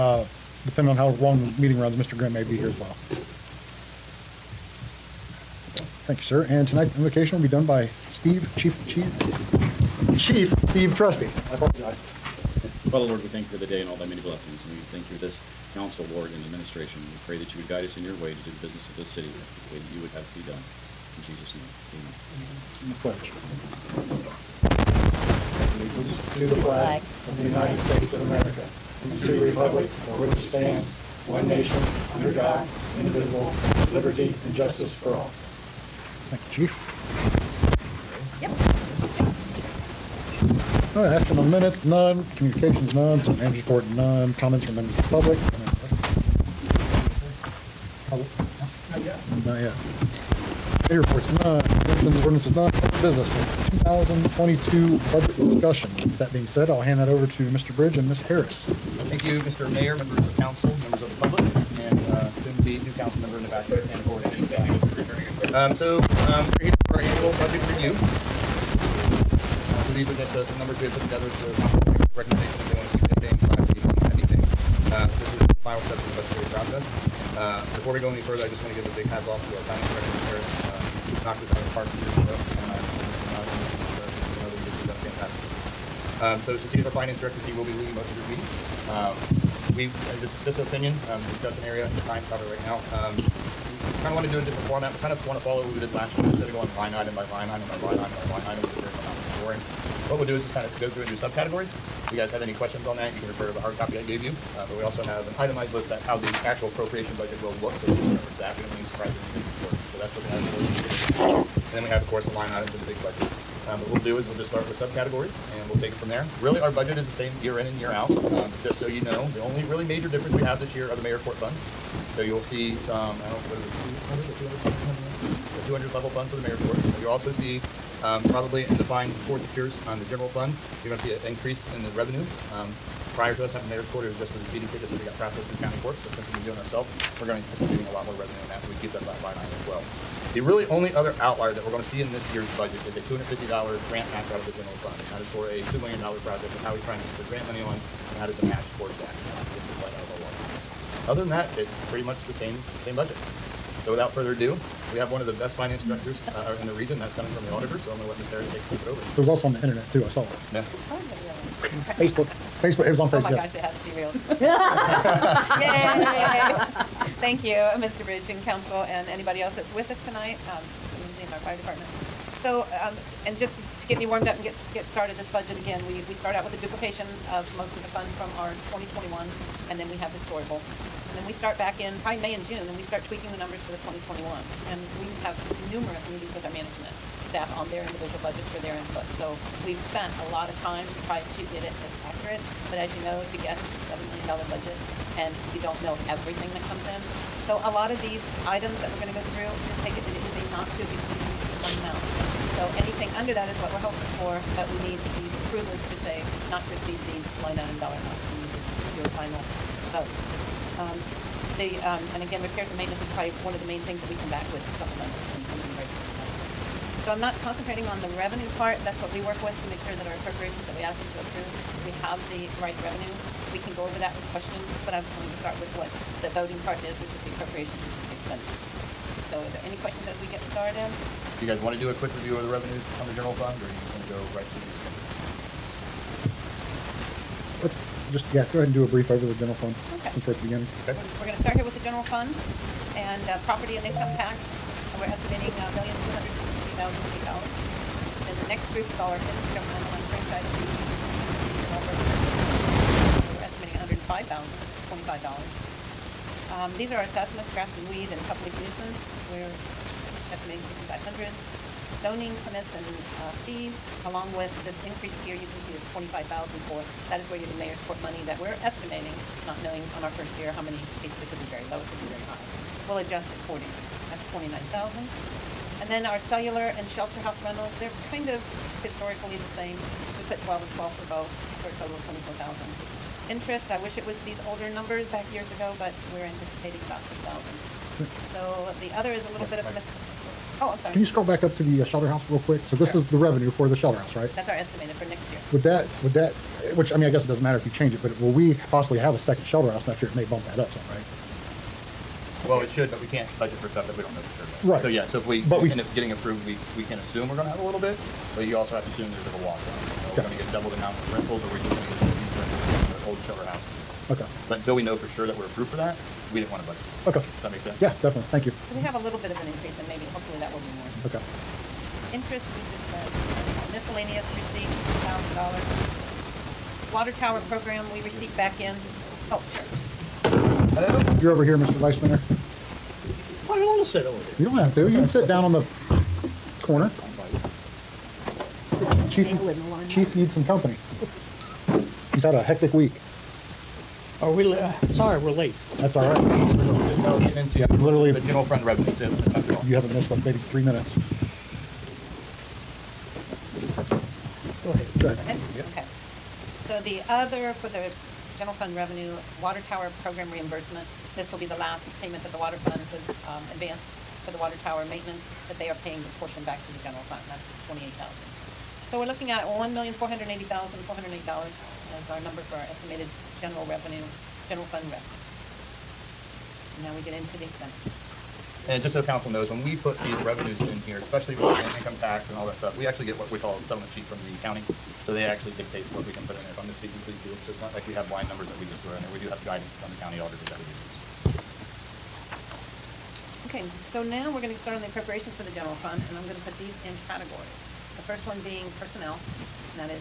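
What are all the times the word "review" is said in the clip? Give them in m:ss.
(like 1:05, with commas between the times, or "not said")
1:07, 3:52.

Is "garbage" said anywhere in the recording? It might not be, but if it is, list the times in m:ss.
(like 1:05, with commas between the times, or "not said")
not said.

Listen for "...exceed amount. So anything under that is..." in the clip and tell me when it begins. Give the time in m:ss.
3:20.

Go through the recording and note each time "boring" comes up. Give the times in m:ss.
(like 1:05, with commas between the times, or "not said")
1:39.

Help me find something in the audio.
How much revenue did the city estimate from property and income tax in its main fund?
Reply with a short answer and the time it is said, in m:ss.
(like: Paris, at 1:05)
$1,250,000, at 4:05.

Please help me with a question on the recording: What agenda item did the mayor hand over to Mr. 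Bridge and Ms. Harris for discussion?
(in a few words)
2022 budget discussion.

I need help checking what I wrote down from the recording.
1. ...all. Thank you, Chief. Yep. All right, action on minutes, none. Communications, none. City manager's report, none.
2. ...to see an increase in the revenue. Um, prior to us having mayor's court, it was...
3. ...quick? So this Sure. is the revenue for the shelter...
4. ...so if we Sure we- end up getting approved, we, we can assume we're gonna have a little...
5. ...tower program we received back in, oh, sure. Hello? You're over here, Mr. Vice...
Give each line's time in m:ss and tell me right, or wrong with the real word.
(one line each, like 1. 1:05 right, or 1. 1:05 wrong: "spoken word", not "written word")
1. 0:35 right
2. 2:11 right
3. 4:52 right
4. 5:05 wrong: "But", not "Sure"
5. 5:27 right.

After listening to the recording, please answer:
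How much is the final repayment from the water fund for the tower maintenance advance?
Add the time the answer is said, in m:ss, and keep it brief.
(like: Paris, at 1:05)
28,000, at 6:07.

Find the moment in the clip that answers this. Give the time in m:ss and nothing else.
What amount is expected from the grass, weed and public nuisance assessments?
4:20.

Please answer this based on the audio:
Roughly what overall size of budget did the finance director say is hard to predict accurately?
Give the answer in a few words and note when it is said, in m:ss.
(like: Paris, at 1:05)
$7 million, at 3:13.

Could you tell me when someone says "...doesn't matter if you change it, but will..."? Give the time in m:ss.
4:57.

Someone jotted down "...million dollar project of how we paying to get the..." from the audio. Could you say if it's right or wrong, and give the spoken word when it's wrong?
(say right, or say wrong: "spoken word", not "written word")
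wrong: "trying", not "paying".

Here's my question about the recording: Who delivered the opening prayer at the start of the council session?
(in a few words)
Chief Steve Trusty.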